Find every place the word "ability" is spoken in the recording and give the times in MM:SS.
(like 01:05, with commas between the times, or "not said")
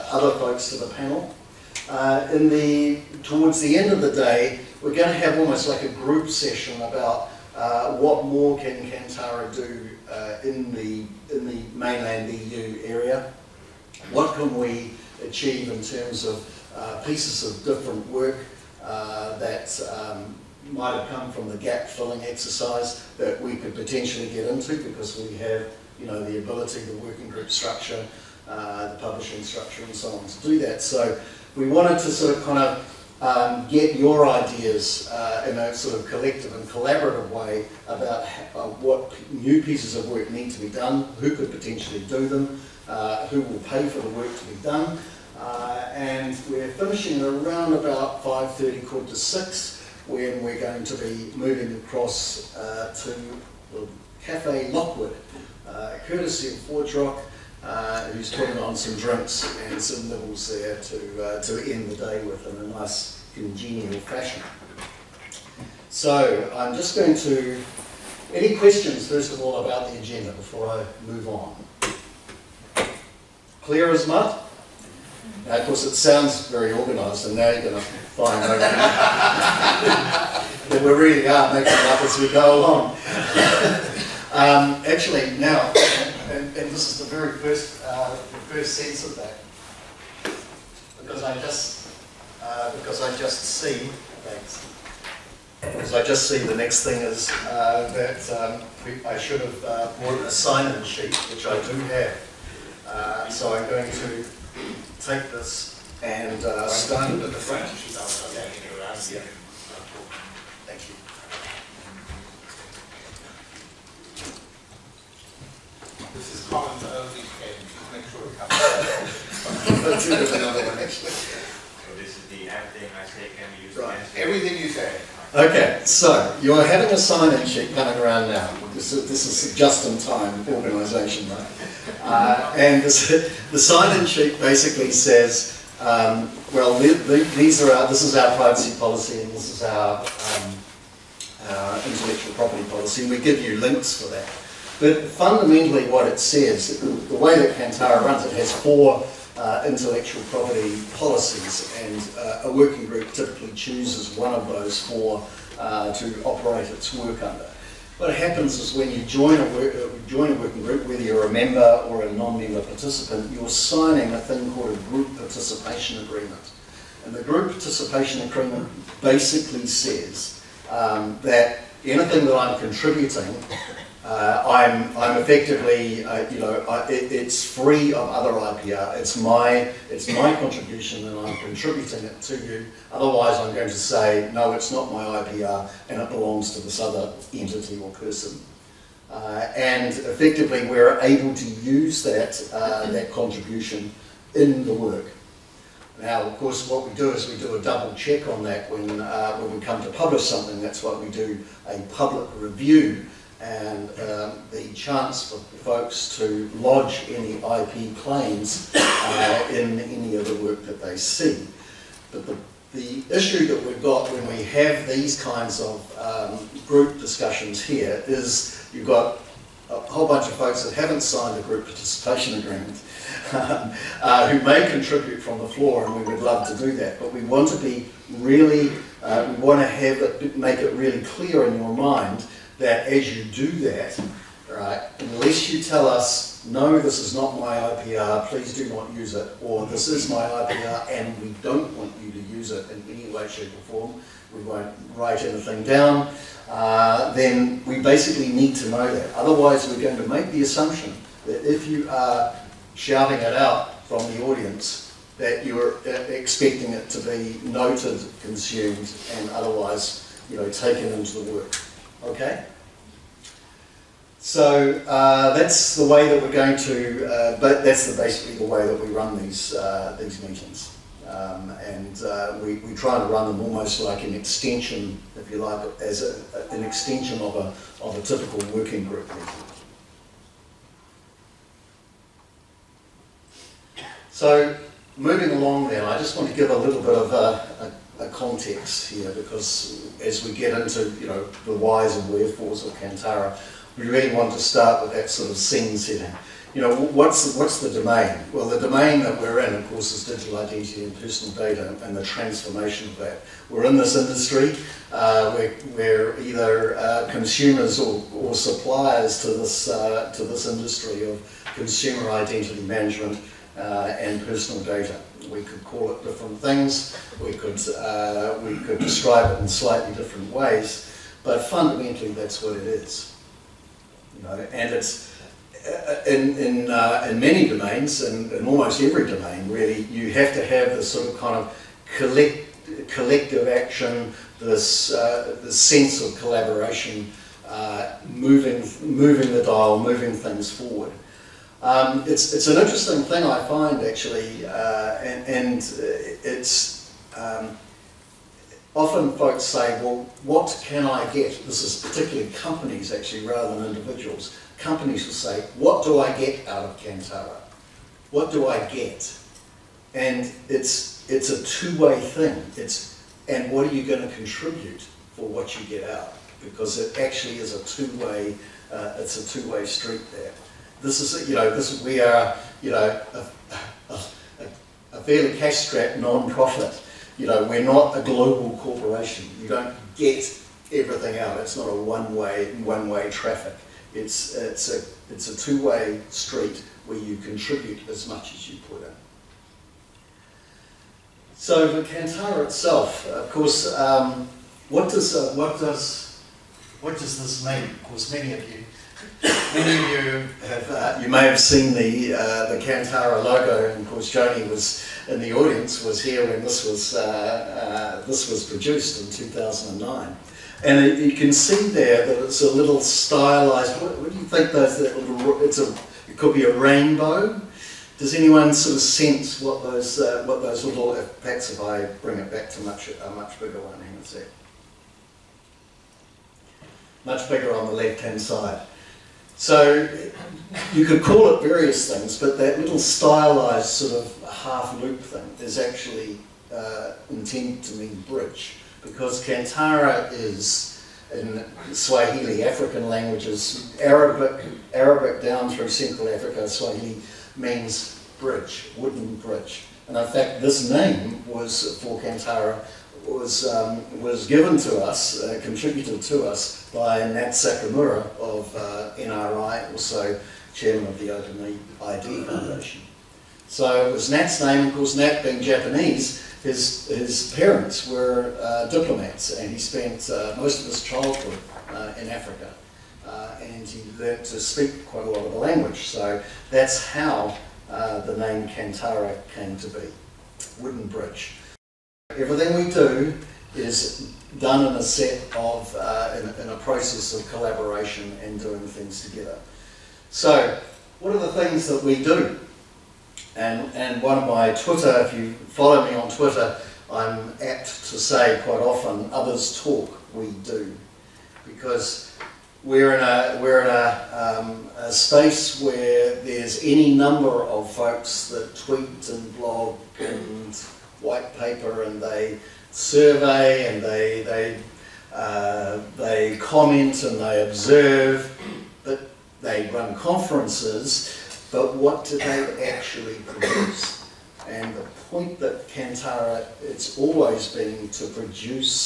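00:26.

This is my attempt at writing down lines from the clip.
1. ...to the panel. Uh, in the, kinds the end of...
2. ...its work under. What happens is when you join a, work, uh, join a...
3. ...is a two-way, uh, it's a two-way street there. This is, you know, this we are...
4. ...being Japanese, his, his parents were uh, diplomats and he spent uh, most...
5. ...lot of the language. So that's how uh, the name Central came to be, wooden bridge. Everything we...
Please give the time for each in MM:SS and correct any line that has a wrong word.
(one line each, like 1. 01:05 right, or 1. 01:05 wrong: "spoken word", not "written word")
1. 00:00 wrong: "towards", not "kinds"
2. 02:36 right
3. 06:07 right
4. 07:45 right
5. 07:55 wrong: "Kantara", not "Central".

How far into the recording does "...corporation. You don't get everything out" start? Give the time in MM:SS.
06:18.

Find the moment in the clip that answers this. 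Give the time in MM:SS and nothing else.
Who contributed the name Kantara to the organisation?
07:36.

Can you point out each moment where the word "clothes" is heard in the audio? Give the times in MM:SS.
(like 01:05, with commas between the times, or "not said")
not said.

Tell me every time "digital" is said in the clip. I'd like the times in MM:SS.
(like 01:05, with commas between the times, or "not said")
05:00.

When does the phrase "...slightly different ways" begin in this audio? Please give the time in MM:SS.
05:19.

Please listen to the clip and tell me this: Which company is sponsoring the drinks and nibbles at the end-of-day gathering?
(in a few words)
ForgeRock.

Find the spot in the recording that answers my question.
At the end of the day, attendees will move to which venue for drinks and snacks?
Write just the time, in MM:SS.
00:54.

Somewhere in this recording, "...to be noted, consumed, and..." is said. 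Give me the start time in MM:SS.
04:16.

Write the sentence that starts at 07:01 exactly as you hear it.
If I bring it back to much a much bigger one, hang on a sec.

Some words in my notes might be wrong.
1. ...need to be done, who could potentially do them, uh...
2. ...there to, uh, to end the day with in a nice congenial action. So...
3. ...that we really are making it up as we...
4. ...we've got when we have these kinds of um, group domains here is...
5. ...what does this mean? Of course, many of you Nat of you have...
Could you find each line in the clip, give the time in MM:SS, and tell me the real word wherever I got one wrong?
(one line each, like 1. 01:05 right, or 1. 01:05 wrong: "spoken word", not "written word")
1. 00:40 right
2. 01:00 wrong: "fashion", not "action"
3. 01:18 right
4. 03:33 wrong: "discussions", not "domains"
5. 06:36 wrong: "Many", not "Nat".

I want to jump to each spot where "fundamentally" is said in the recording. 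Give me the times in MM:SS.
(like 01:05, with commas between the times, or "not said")
02:25, 05:21.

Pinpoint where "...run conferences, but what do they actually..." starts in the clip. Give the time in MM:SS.
08:39.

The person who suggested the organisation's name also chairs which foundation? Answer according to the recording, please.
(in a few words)
Open ID Foundation.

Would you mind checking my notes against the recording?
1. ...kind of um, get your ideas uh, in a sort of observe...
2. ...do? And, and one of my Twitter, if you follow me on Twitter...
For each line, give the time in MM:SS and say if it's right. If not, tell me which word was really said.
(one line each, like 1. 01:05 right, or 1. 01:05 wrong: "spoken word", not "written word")
1. 00:32 wrong: "collective", not "observe"
2. 08:12 right.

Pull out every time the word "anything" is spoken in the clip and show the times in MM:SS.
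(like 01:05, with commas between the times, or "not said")
02:51, 04:05.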